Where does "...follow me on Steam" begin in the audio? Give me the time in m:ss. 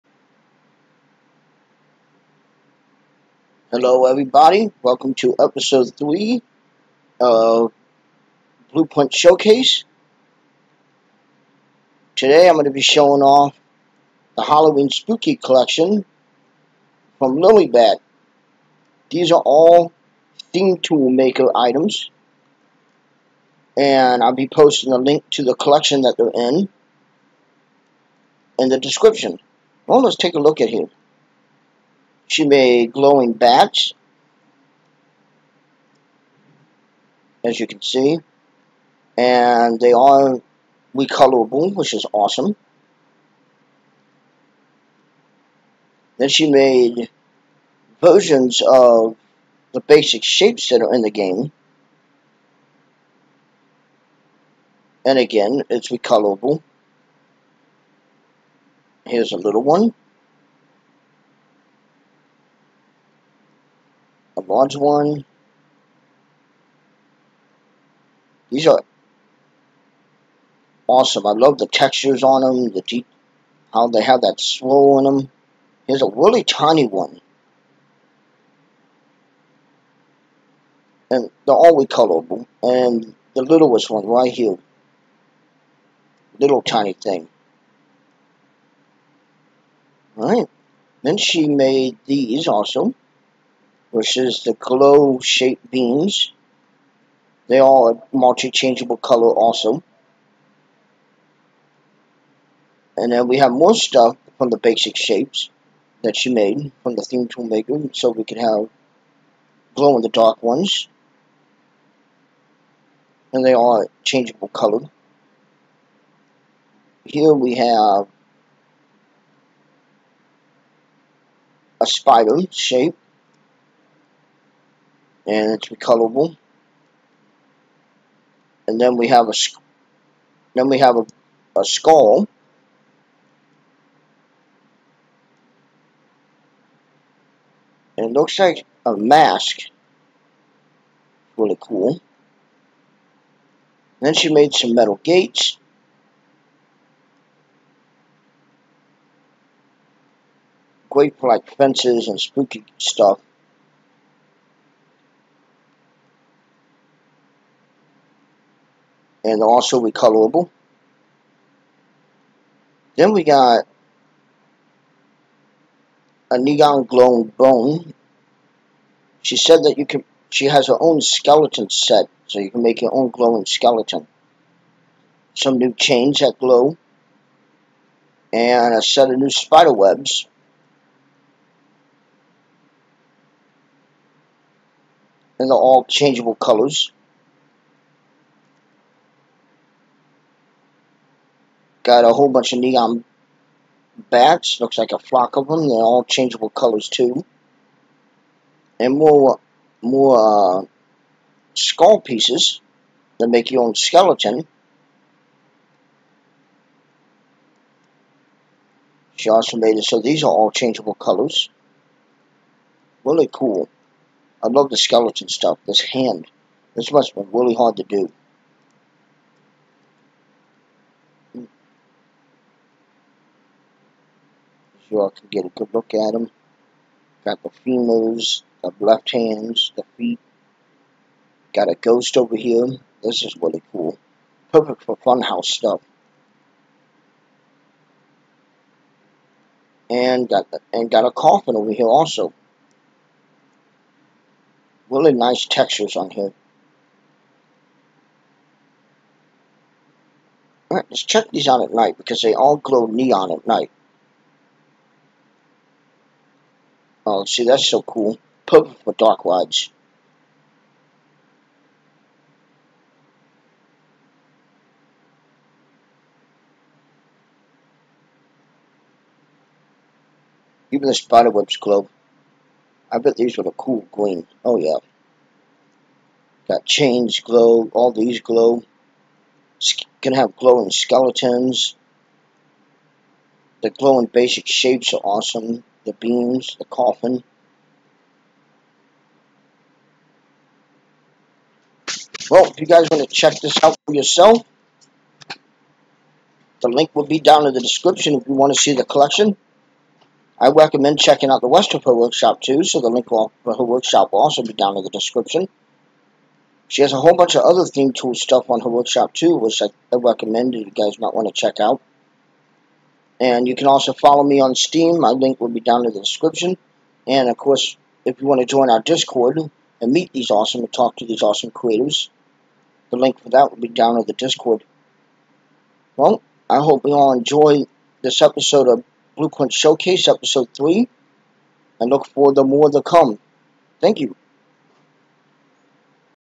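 5:13.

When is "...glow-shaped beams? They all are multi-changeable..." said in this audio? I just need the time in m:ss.
1:34.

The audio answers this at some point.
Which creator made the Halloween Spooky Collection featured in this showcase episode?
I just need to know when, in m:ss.
0:17.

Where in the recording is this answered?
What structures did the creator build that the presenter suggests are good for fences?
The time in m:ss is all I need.
2:24.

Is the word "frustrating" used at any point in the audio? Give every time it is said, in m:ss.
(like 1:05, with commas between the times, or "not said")
not said.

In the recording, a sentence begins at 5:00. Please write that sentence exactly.
I recommend checking out the Westerford Workshop too, so the link for her workshop will also be down in the description.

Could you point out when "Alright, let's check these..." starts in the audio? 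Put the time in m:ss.
4:10.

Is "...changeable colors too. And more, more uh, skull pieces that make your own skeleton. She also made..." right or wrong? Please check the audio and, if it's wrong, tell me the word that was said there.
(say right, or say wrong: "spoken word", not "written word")
right.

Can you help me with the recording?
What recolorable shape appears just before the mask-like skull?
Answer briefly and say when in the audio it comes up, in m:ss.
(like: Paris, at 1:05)
spider shape, at 2:01.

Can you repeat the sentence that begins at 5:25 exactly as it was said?
Well, I hope you all enjoy this episode of Blueprint Showcase, episode 3, and look forward to more to come.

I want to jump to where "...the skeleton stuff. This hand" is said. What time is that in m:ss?
3:34.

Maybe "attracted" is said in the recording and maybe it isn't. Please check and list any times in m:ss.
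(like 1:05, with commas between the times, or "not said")
not said.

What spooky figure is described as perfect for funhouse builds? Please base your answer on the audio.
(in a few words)
ghost.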